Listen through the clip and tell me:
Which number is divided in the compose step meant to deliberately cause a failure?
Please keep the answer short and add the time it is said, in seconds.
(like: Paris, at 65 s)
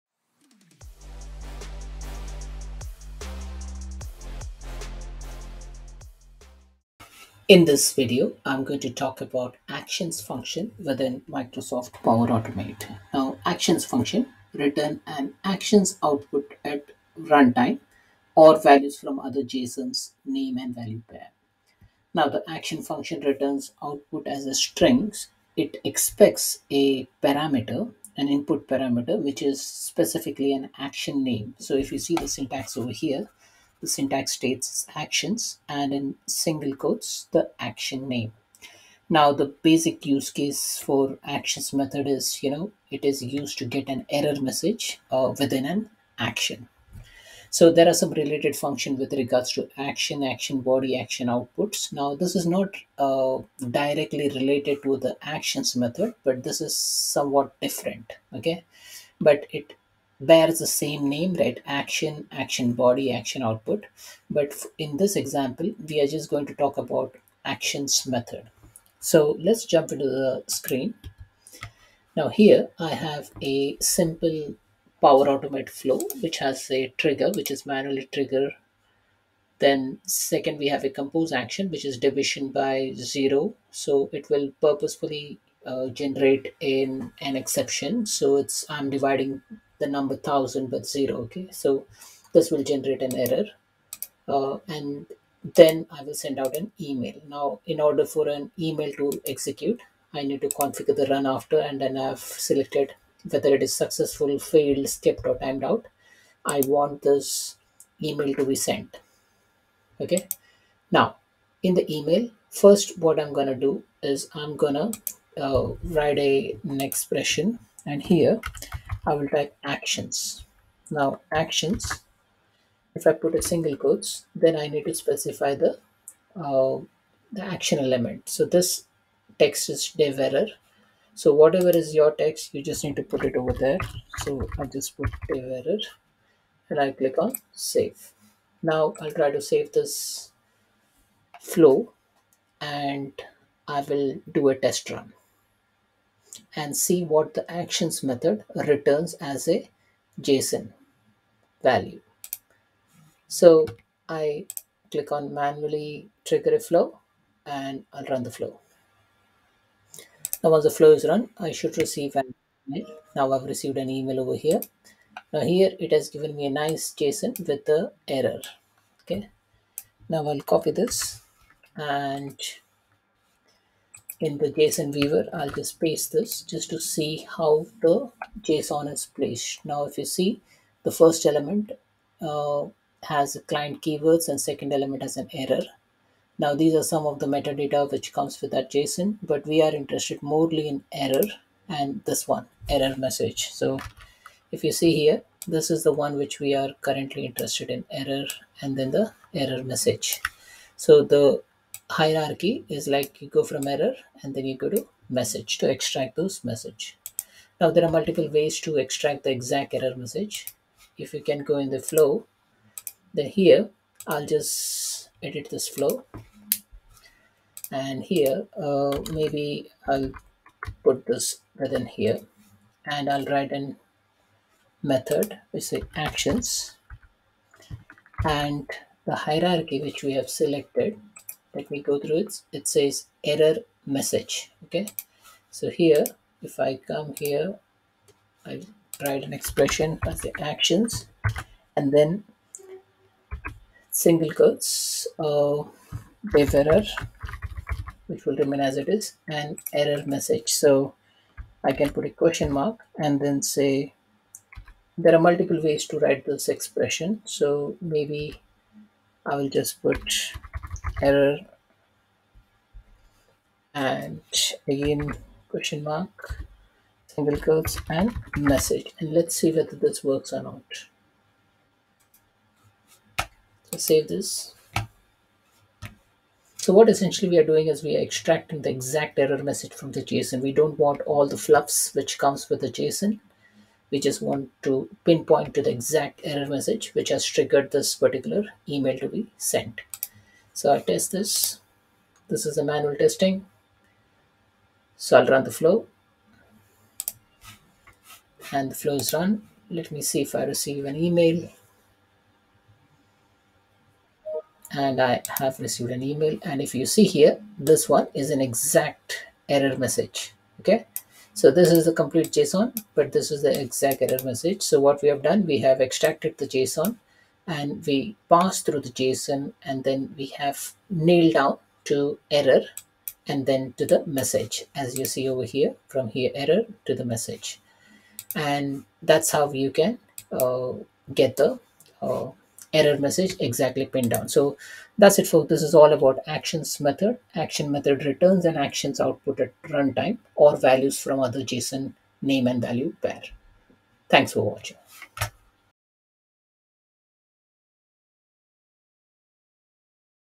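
1000, at 90 s.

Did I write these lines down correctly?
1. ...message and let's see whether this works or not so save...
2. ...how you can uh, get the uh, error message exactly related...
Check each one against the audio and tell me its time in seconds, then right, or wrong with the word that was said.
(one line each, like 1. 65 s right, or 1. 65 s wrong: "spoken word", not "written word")
1. 268 s right
2. 329 s wrong: "pinned", not "related".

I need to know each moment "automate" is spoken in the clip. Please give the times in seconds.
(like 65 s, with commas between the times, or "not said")
12 s, 75 s.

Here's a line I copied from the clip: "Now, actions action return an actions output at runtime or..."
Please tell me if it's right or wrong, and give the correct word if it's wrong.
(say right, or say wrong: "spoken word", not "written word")
wrong: "function", not "action".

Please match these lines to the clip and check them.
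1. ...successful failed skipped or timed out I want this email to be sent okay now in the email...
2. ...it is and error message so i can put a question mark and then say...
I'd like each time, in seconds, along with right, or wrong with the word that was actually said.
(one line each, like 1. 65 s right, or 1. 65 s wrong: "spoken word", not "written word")
1. 103 s right
2. 248 s right.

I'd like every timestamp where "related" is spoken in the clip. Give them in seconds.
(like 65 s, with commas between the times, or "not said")
48 s, 54 s.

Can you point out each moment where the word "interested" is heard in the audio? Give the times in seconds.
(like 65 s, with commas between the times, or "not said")
189 s, 197 s.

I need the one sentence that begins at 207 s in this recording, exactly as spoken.
Now there are multiple ways to extract the exact error message.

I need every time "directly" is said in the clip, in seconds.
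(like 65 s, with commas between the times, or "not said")
53 s.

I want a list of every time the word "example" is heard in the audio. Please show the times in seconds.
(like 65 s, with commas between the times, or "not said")
65 s.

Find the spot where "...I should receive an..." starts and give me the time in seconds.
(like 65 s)
161 s.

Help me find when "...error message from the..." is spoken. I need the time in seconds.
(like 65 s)
279 s.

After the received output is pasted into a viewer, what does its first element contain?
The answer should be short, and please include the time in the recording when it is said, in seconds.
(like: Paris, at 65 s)
client keywords, at 183 s.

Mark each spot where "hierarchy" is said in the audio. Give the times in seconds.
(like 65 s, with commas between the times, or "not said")
201 s, 229 s.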